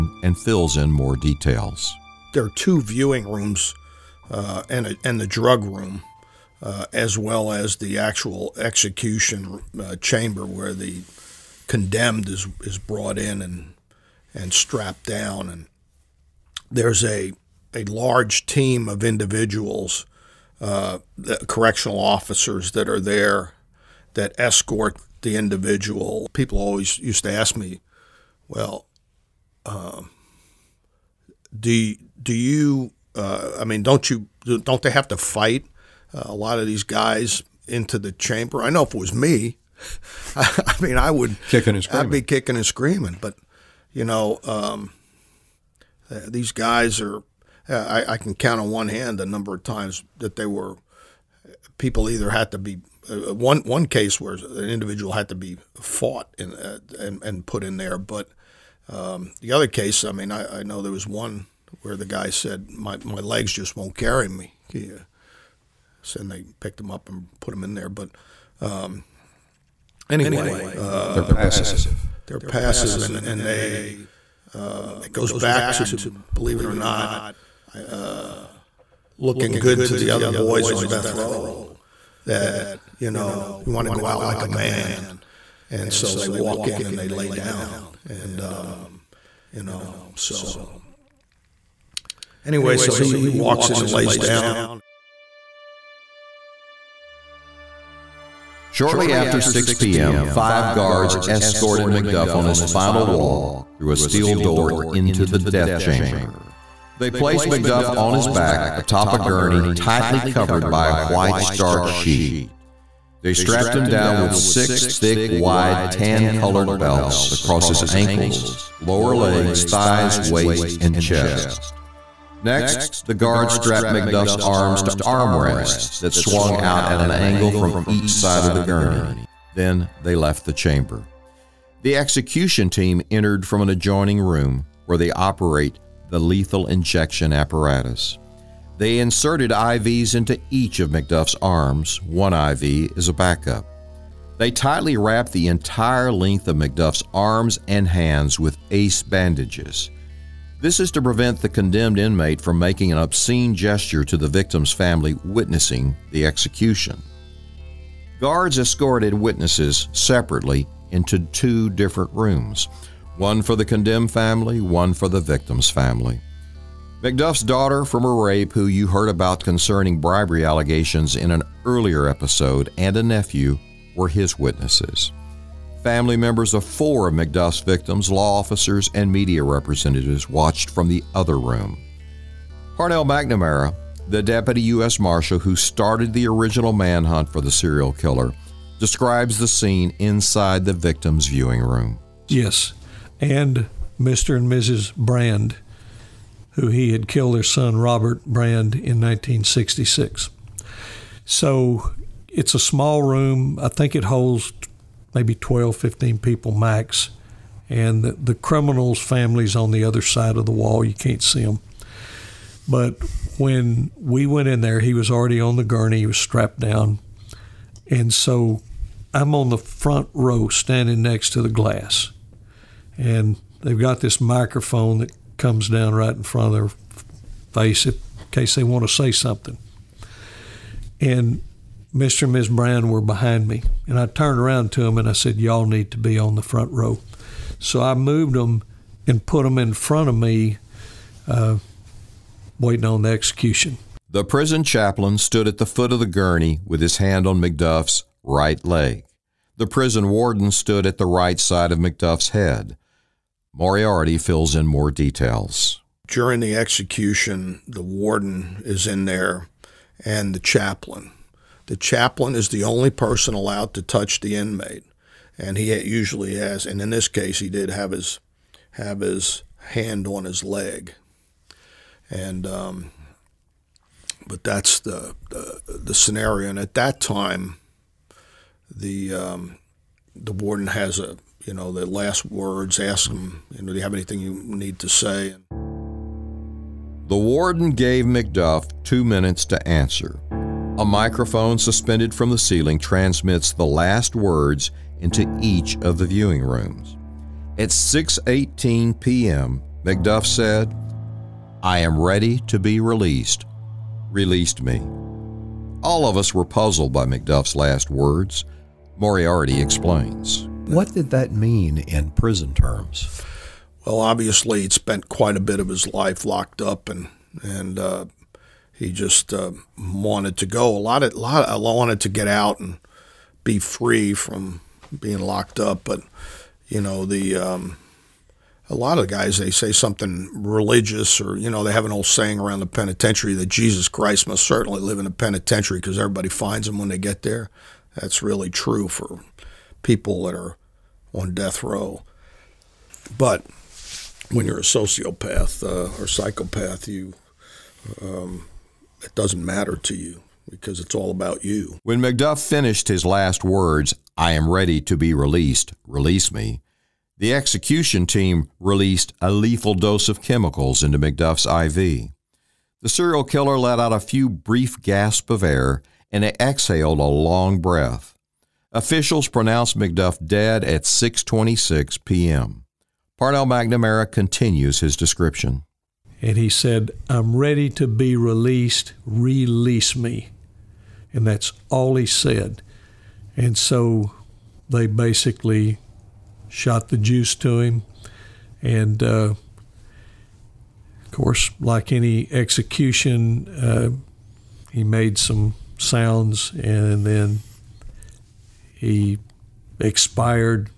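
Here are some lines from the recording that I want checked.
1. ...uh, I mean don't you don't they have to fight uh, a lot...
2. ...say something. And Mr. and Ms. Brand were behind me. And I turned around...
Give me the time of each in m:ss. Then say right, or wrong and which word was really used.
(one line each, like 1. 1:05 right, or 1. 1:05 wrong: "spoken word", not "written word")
1. 0:33 right
2. 3:48 right.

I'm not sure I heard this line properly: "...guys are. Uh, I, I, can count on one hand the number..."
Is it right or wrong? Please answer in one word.
right.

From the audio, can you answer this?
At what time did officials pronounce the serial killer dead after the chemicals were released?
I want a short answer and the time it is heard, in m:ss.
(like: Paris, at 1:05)
6:26 p.m., at 6:10.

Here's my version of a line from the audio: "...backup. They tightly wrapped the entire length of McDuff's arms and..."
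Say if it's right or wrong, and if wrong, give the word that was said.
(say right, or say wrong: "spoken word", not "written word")
right.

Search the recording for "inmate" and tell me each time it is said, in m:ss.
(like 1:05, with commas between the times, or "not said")
2:31, 4:24.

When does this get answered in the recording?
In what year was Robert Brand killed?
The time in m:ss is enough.
3:18.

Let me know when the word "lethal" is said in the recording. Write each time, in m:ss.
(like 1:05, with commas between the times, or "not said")
2:16, 5:59.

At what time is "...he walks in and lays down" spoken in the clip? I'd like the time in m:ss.
1:33.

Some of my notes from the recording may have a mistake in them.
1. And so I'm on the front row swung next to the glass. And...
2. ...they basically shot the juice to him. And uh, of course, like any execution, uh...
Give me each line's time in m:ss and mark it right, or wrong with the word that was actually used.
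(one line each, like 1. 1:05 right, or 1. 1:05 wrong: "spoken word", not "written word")
1. 3:37 wrong: "standing", not "swung"
2. 6:24 right.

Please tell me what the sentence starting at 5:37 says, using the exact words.
That's really true for people that are on death row.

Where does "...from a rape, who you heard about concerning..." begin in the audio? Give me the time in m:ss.
2:47.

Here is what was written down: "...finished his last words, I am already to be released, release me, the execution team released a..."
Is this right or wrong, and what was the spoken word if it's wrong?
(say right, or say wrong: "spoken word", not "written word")
wrong: "ready", not "already".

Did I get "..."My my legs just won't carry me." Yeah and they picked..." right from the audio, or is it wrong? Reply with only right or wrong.
right.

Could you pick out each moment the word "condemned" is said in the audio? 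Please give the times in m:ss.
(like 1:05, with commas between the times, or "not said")
0:11, 2:31, 2:43.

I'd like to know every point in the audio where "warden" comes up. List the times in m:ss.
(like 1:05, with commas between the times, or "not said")
4:10, 4:17, 4:40, 4:47.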